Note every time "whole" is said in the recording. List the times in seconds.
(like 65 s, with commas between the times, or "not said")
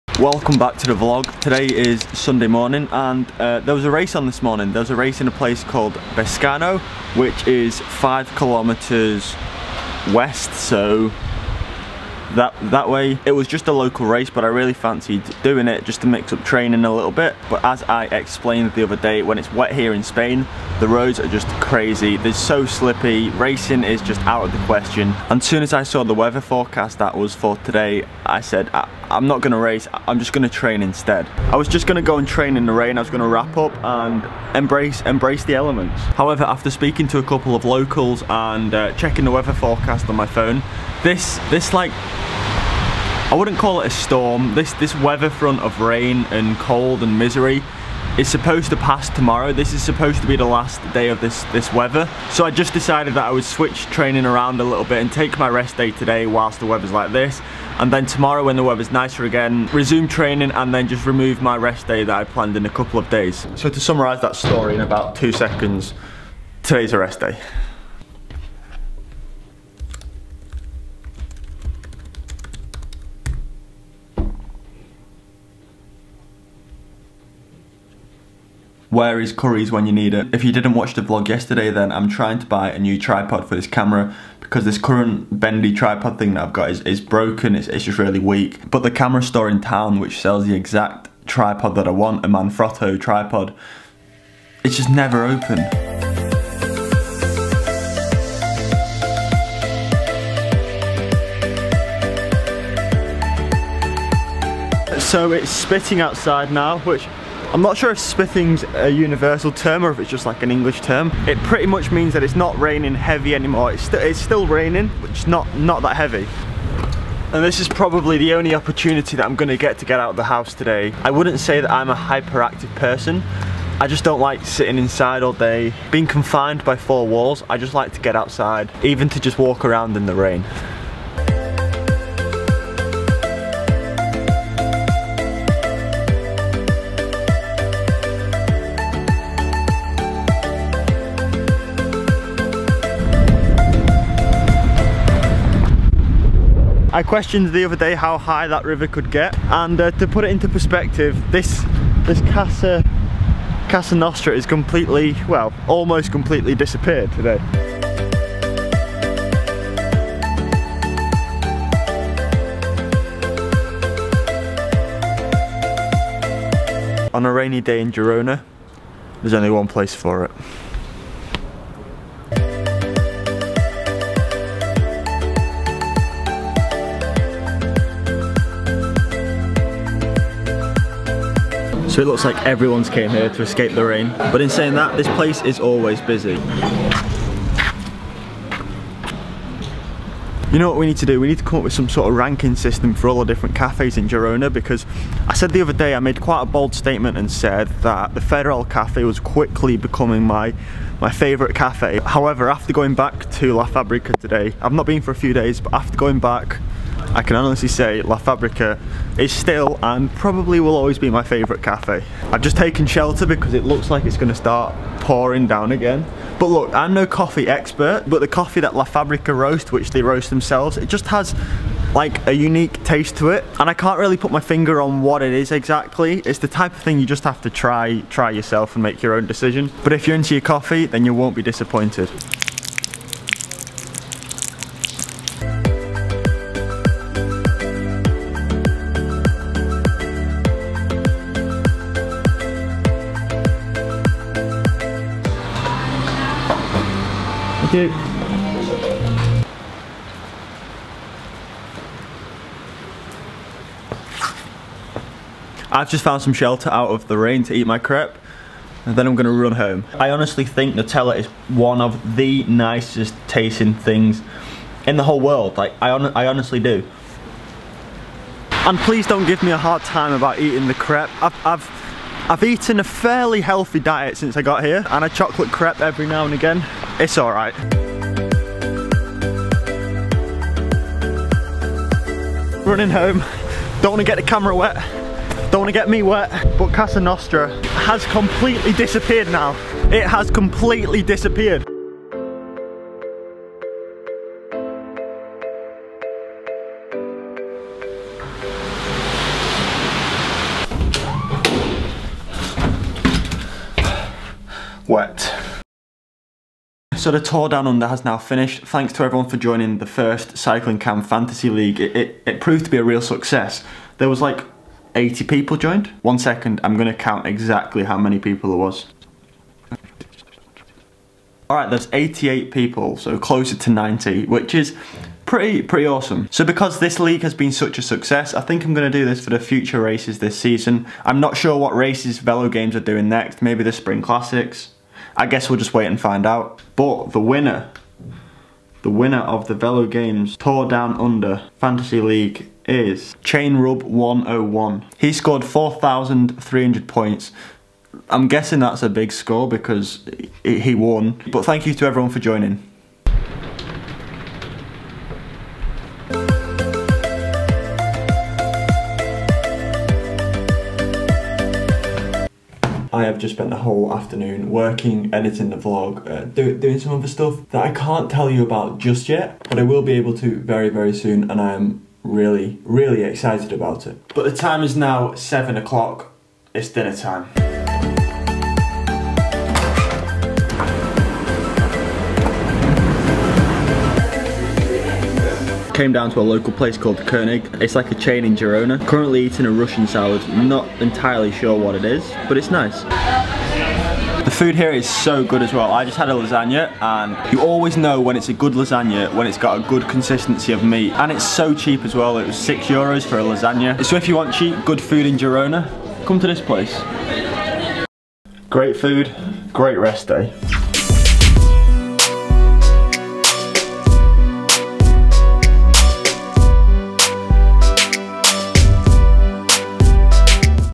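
265 s, 363 s.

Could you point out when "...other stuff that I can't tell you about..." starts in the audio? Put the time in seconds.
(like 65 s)
366 s.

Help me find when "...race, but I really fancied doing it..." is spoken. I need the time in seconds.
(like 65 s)
14 s.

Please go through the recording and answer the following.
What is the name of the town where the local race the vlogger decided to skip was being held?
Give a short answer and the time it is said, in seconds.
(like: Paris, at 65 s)
Bescano, at 6 s.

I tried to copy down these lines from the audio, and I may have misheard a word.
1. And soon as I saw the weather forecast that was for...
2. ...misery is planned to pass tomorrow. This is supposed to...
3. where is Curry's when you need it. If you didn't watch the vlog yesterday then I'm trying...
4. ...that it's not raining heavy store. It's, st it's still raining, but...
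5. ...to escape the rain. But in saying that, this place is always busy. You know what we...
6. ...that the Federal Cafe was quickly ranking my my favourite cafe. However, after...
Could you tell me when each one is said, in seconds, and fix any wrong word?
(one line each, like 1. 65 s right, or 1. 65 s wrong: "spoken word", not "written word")
1. 25 s right
2. 47 s wrong: "supposed", not "planned"
3. 78 s right
4. 112 s wrong: "anymore", not "store"
5. 183 s right
6. 197 s wrong: "becoming", not "ranking".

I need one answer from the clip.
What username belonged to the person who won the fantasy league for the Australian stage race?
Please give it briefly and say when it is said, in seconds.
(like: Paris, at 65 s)
Chain Rub 101, at 343 s.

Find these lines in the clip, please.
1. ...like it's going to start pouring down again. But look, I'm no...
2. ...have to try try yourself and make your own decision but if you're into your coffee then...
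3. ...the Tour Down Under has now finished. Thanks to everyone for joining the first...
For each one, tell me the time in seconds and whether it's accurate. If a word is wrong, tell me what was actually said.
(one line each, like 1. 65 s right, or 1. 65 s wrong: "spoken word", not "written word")
1. 213 s right
2. 227 s right
3. 307 s right.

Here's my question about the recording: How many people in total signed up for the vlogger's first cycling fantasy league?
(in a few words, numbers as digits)
88.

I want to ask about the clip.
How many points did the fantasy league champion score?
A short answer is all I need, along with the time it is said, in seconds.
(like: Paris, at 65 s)
4,300, at 345 s.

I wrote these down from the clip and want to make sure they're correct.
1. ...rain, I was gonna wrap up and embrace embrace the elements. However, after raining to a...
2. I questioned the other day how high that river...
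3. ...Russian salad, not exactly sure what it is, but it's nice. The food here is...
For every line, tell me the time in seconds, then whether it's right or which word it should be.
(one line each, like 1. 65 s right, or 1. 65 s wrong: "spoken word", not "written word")
1. 32 s wrong: "speaking", not "raining"
2. 146 s right
3. 389 s wrong: "entirely", not "exactly".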